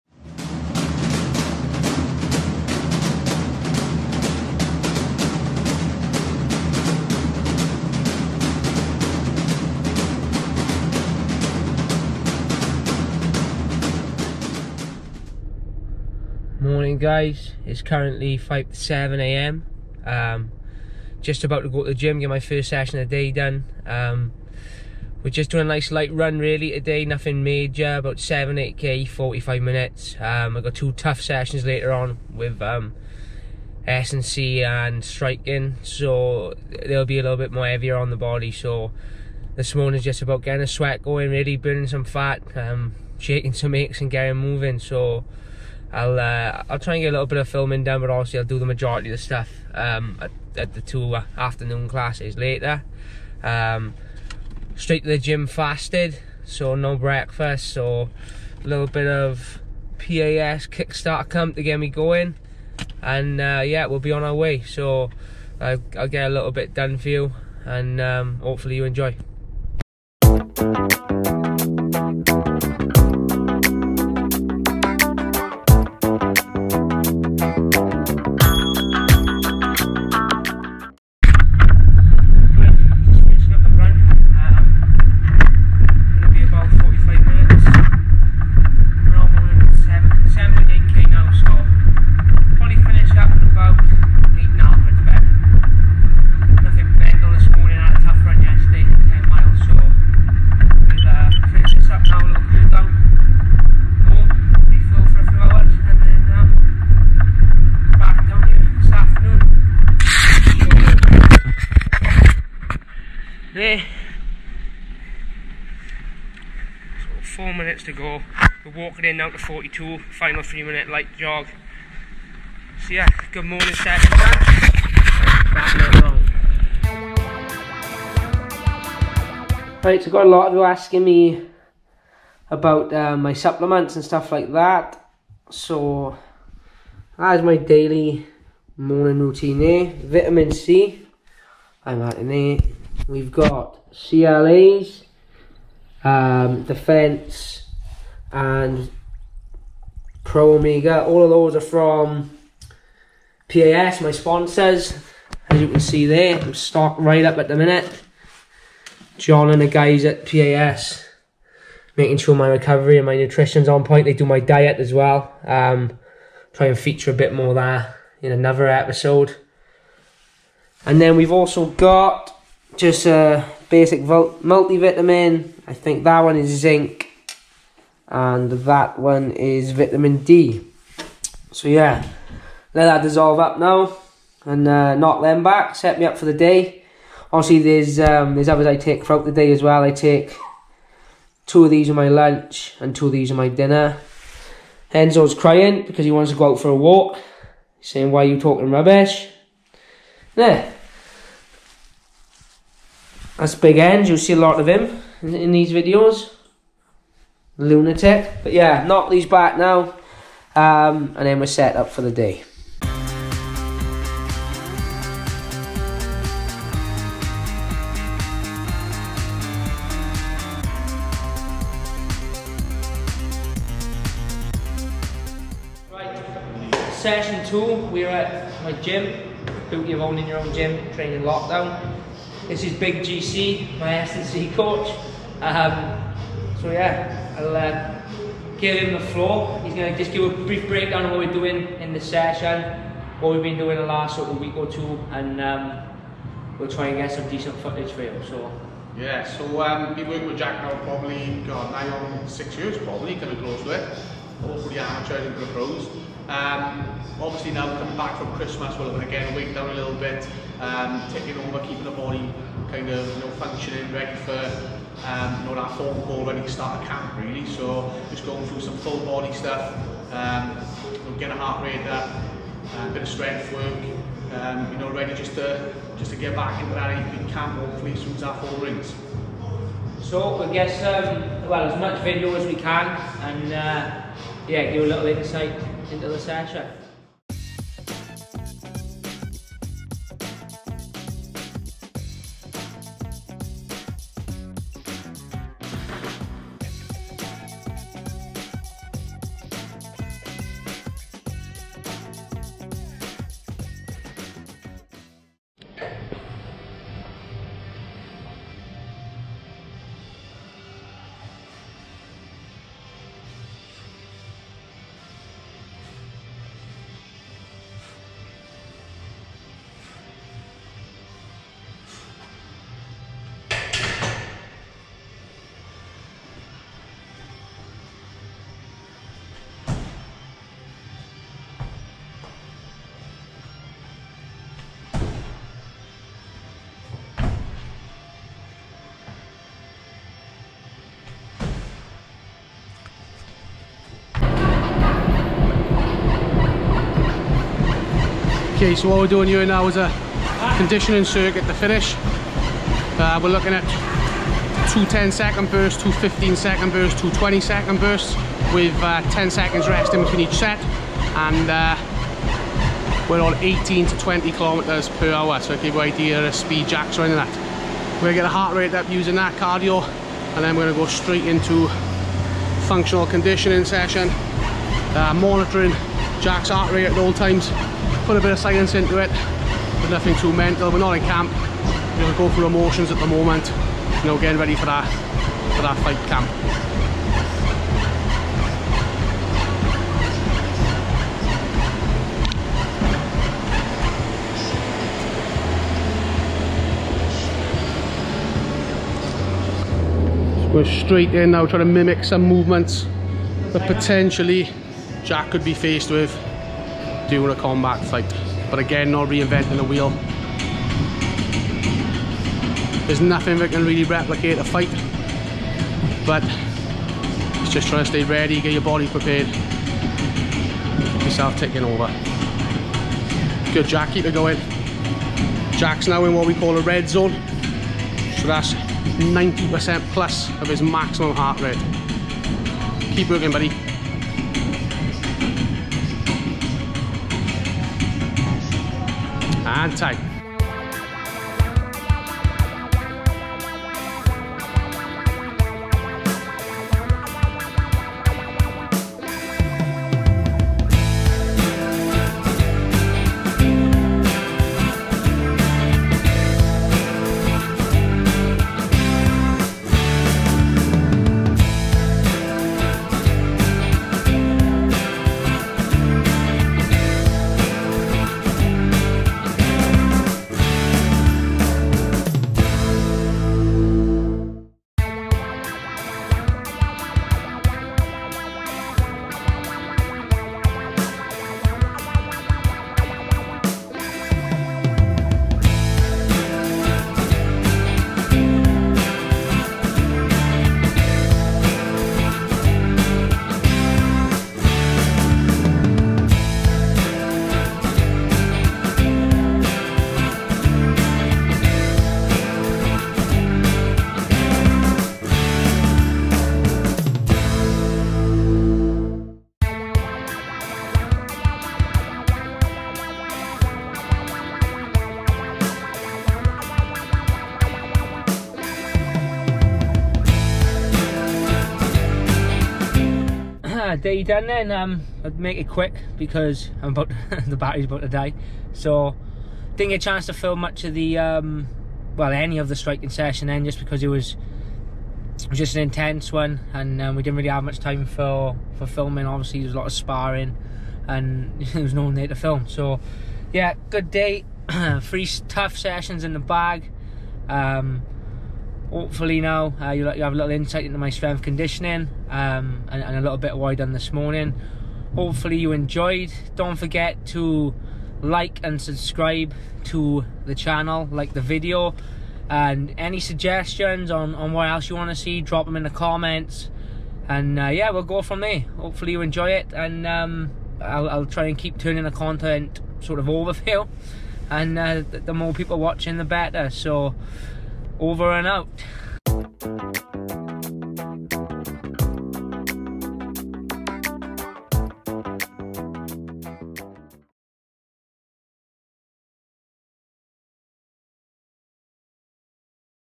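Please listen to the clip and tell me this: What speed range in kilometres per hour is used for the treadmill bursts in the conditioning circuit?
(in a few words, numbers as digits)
18 to 20 km/h.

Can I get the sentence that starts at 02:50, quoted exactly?
And then we've also got just a basic multivitamin.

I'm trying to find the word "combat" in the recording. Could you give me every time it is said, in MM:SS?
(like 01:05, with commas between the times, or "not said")
06:47.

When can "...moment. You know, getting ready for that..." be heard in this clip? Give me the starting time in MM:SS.
06:23.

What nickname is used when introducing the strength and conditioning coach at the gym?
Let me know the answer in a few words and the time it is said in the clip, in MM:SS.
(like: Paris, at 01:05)
Big GC, at 03:52.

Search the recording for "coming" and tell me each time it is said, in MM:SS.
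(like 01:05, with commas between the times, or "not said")
04:13, 04:17.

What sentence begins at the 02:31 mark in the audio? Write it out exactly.
All of those are from PAS, my sponsors.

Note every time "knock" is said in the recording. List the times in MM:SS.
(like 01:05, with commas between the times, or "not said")
03:04, 03:28.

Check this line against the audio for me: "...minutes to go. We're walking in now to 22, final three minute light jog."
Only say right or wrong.
wrong.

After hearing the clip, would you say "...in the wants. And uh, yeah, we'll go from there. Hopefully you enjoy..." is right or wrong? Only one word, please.
wrong.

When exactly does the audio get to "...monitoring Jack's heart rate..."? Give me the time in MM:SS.
06:15.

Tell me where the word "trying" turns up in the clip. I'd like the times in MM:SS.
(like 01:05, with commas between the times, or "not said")
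06:41, 06:57.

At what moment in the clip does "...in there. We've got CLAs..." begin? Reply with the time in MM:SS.
02:22.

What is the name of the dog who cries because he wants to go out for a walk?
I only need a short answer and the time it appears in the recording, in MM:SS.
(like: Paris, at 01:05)
Enzo, at 03:14.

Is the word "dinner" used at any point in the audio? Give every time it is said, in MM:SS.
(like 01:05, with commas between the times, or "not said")
03:13.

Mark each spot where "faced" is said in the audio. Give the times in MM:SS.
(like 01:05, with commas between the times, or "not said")
06:45.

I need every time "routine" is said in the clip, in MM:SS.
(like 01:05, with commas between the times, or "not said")
02:19.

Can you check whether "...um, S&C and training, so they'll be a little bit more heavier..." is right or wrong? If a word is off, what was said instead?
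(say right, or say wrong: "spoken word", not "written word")
wrong: "striking", not "training".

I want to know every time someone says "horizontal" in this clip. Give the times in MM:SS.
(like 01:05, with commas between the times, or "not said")
not said.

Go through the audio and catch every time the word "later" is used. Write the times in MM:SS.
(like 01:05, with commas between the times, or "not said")
00:31, 00:52.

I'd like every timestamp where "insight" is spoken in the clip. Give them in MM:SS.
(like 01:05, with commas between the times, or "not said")
04:45, 09:10.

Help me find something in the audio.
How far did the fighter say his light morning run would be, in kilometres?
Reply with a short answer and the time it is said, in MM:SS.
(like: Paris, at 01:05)
7 to 8 km, at 00:27.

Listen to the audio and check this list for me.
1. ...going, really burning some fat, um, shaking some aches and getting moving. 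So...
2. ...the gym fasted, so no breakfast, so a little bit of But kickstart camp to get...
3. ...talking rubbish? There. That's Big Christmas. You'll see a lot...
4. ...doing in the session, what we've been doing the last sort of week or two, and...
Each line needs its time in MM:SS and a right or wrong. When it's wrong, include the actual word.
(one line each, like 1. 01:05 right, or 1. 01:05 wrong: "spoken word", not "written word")
1. 00:41 right
2. 00:55 wrong: "PAS", not "But"
3. 03:18 wrong: "End", not "Christmas"
4. 04:01 right.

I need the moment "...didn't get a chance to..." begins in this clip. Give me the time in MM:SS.
08:49.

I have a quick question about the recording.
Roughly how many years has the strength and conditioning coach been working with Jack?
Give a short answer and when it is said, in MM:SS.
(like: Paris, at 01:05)
6, at 04:12.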